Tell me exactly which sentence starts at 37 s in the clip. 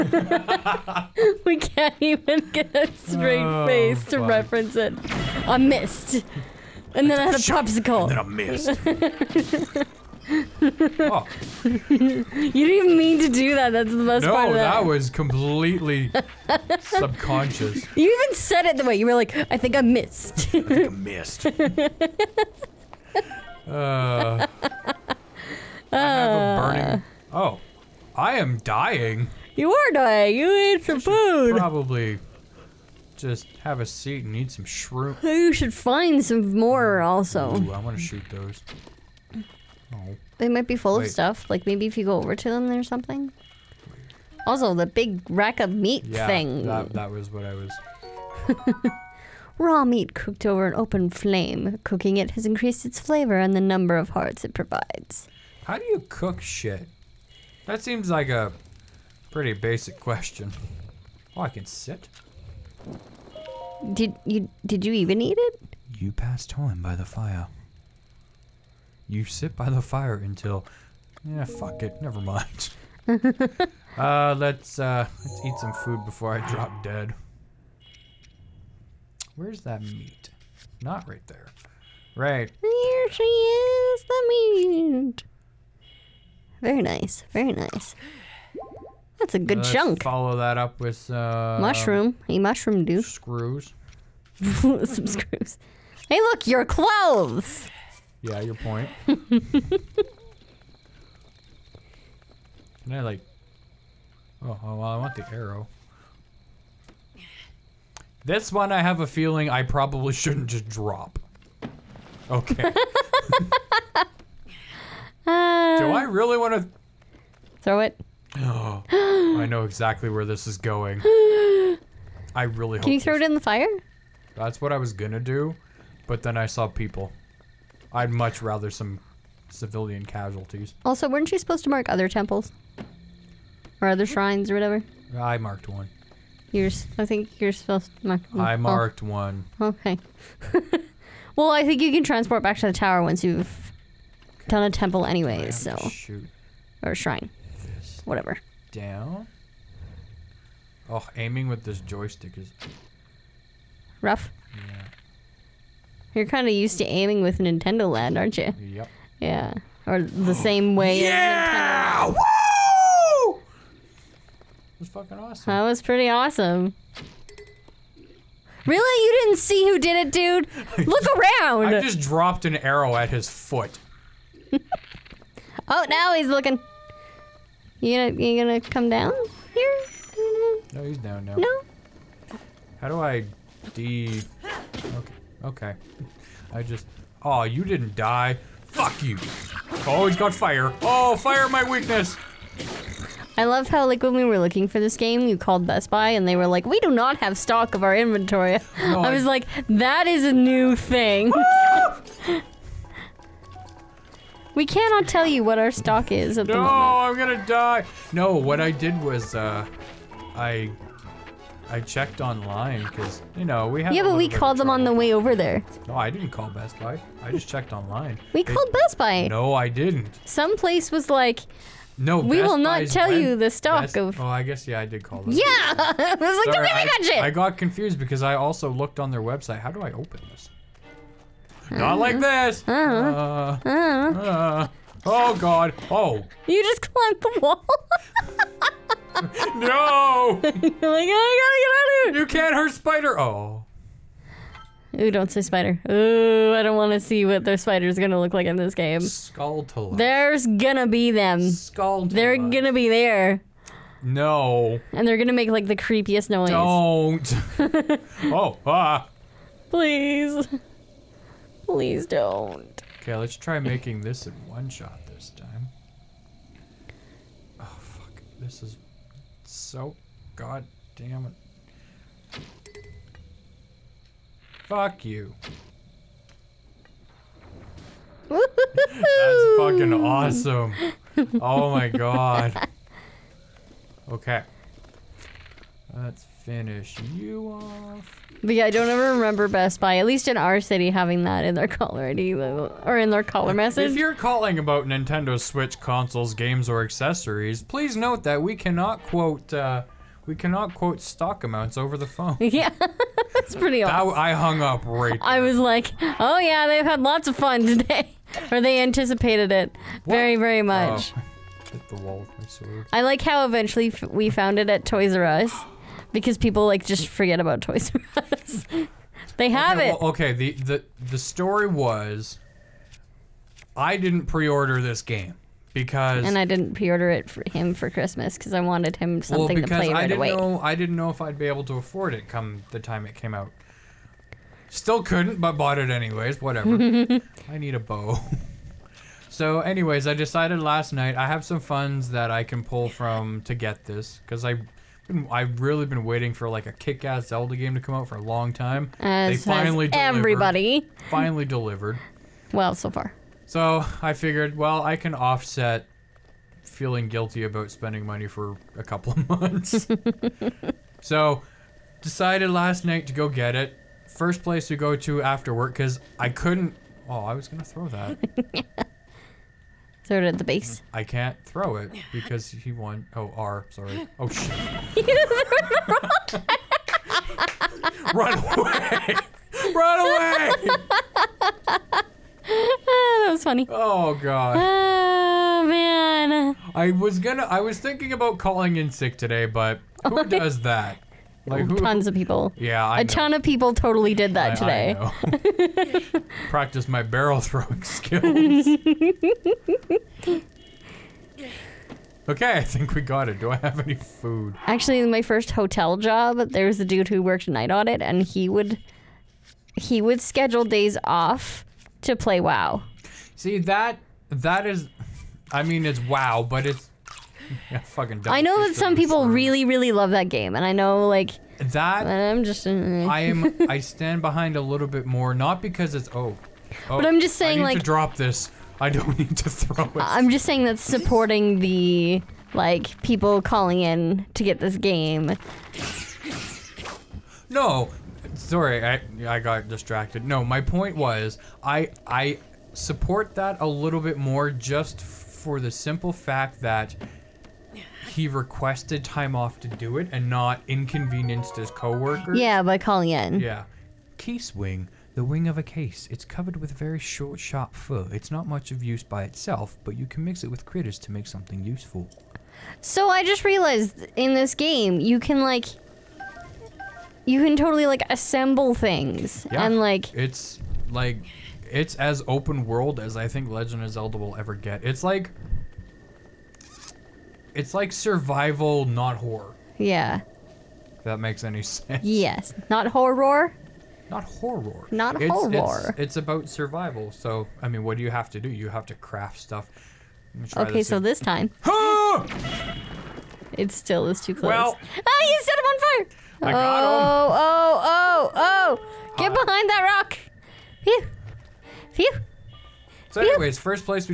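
Ooh, I want to shoot those.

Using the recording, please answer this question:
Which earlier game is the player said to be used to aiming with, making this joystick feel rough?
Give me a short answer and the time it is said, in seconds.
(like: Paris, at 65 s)
Nintendo Land, at 157 s.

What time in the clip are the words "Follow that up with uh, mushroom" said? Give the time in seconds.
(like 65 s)
90 s.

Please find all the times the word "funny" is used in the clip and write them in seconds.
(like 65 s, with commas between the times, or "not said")
383 s.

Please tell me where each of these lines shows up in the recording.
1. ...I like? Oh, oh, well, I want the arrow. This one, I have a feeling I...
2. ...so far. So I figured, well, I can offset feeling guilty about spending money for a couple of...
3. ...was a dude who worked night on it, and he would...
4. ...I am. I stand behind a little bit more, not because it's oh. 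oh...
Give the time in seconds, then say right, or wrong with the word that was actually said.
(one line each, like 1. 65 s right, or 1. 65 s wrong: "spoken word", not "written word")
1. 102 s right
2. 352 s right
3. 406 s right
4. 423 s right.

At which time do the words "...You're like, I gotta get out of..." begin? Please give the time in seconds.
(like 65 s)
240 s.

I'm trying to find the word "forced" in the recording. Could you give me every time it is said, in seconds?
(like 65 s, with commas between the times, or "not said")
not said.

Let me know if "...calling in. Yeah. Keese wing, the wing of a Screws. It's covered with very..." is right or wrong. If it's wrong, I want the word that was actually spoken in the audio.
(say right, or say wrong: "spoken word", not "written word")
wrong: "Keese", not "Screws".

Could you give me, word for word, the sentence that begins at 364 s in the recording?
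First place to go to after work because I couldn't.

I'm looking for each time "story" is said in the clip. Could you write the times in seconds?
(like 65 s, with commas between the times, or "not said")
321 s.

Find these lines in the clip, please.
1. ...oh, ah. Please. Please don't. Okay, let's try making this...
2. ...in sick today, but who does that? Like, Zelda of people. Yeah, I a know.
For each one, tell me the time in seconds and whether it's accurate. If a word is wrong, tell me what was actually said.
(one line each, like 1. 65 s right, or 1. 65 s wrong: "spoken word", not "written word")
1. 258 s right
2. 388 s wrong: "Tons", not "Zelda".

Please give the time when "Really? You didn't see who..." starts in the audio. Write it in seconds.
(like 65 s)
168 s.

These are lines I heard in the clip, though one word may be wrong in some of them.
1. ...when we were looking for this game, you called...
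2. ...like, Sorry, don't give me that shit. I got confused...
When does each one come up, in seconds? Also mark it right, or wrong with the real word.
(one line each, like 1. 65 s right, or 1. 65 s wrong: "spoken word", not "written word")
1. 194 s right
2. 225 s right.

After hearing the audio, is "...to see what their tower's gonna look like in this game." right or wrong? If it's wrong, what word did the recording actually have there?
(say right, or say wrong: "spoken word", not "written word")
wrong: "spider", not "tower".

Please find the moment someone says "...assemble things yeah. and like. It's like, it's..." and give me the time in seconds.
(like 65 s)
468 s.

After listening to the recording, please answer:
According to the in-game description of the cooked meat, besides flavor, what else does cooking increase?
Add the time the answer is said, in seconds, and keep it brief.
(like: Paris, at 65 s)
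number of hearts, at 53 s.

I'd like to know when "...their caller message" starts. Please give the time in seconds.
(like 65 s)
293 s.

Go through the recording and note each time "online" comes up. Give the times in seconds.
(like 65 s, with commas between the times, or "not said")
212 s, 217 s.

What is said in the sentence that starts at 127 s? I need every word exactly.
I'd much rather some civilian casualties.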